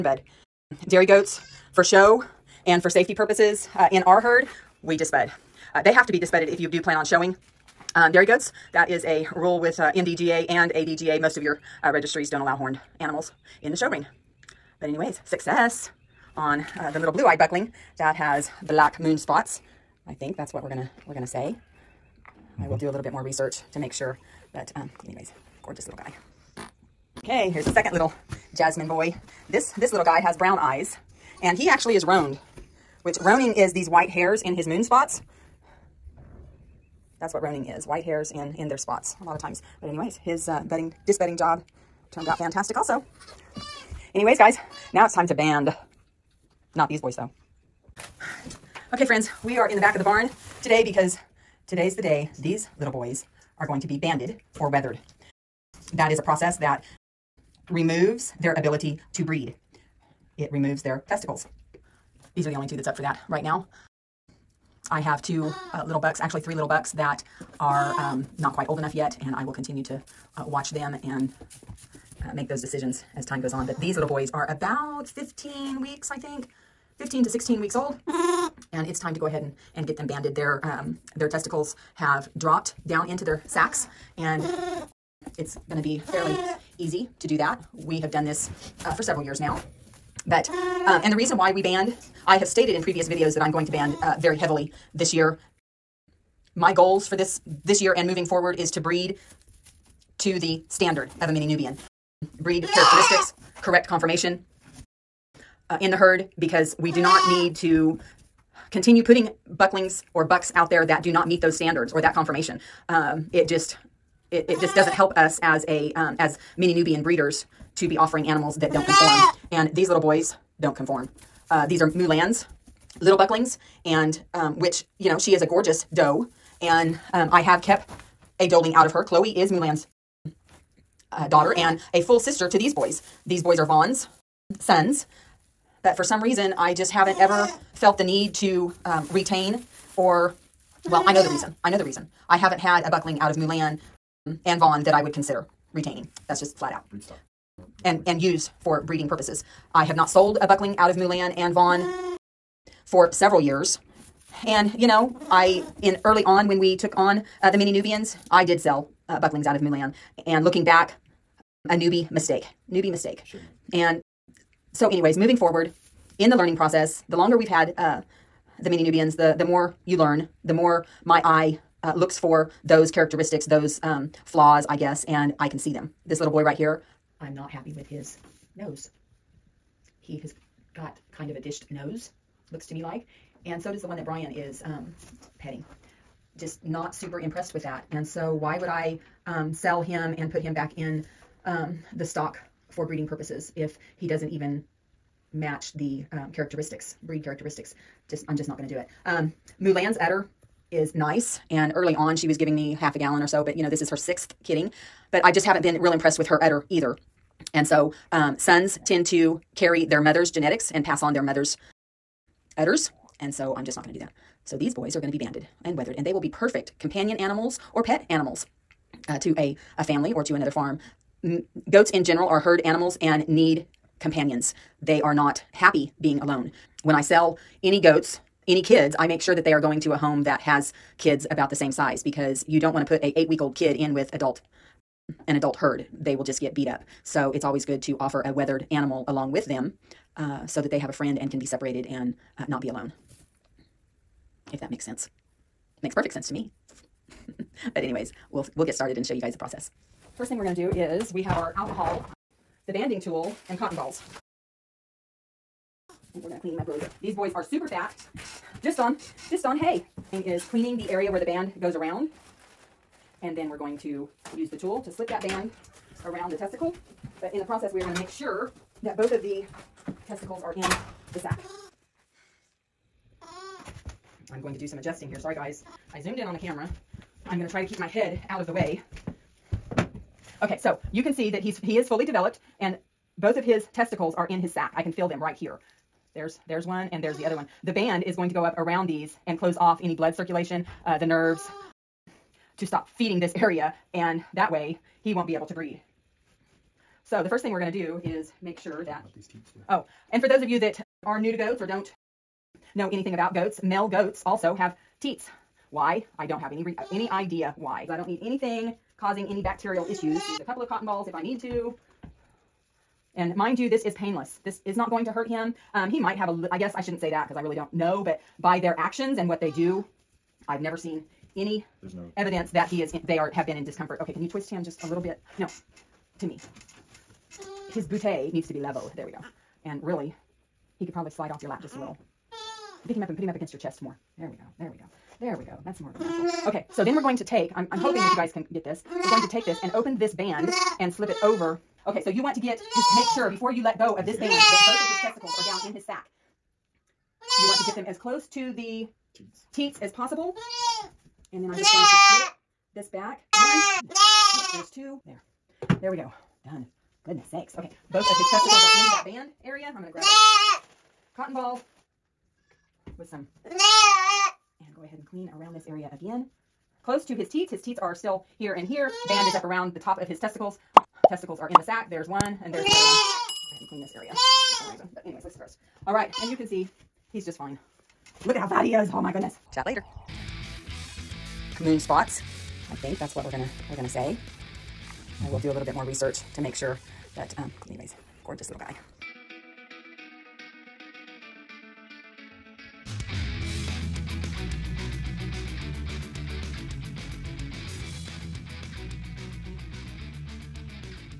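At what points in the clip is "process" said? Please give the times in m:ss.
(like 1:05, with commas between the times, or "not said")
0:56, 2:46, 4:09, 4:27.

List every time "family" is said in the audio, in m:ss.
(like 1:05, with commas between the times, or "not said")
3:39.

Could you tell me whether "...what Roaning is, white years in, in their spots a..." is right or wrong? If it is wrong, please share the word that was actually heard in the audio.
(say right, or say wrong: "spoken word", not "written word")
wrong: "hairs", not "years".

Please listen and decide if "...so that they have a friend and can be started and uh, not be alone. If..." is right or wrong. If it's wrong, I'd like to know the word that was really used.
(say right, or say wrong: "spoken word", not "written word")
wrong: "separated", not "started".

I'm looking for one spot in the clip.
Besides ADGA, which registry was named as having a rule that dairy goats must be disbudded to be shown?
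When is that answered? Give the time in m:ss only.
0:09.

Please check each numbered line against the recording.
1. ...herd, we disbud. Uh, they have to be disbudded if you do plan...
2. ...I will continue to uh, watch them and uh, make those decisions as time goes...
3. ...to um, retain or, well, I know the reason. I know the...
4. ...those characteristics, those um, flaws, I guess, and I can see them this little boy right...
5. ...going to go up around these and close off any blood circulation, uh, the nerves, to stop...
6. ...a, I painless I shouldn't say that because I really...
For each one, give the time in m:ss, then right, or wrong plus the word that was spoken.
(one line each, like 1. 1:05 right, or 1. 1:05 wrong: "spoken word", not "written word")
1. 0:04 right
2. 1:09 right
3. 2:18 right
4. 2:52 right
5. 4:48 right
6. 5:16 wrong: "guess", not "painless".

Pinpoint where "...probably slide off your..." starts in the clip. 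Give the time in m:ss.
5:30.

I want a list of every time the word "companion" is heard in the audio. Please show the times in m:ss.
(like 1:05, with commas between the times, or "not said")
3:36, 3:44.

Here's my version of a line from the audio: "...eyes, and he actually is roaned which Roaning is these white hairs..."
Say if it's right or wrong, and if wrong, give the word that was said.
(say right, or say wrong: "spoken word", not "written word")
right.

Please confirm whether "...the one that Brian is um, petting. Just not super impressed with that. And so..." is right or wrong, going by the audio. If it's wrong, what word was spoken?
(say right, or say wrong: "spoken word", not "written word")
right.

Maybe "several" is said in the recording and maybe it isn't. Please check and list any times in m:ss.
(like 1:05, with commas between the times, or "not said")
1:29, 2:33.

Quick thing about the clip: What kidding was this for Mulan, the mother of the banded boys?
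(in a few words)
Sixth.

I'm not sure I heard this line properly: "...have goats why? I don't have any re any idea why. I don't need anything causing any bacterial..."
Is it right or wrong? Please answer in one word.
wrong.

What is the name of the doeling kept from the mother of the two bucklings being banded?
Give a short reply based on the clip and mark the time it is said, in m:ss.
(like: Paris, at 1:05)
Chloe, at 2:09.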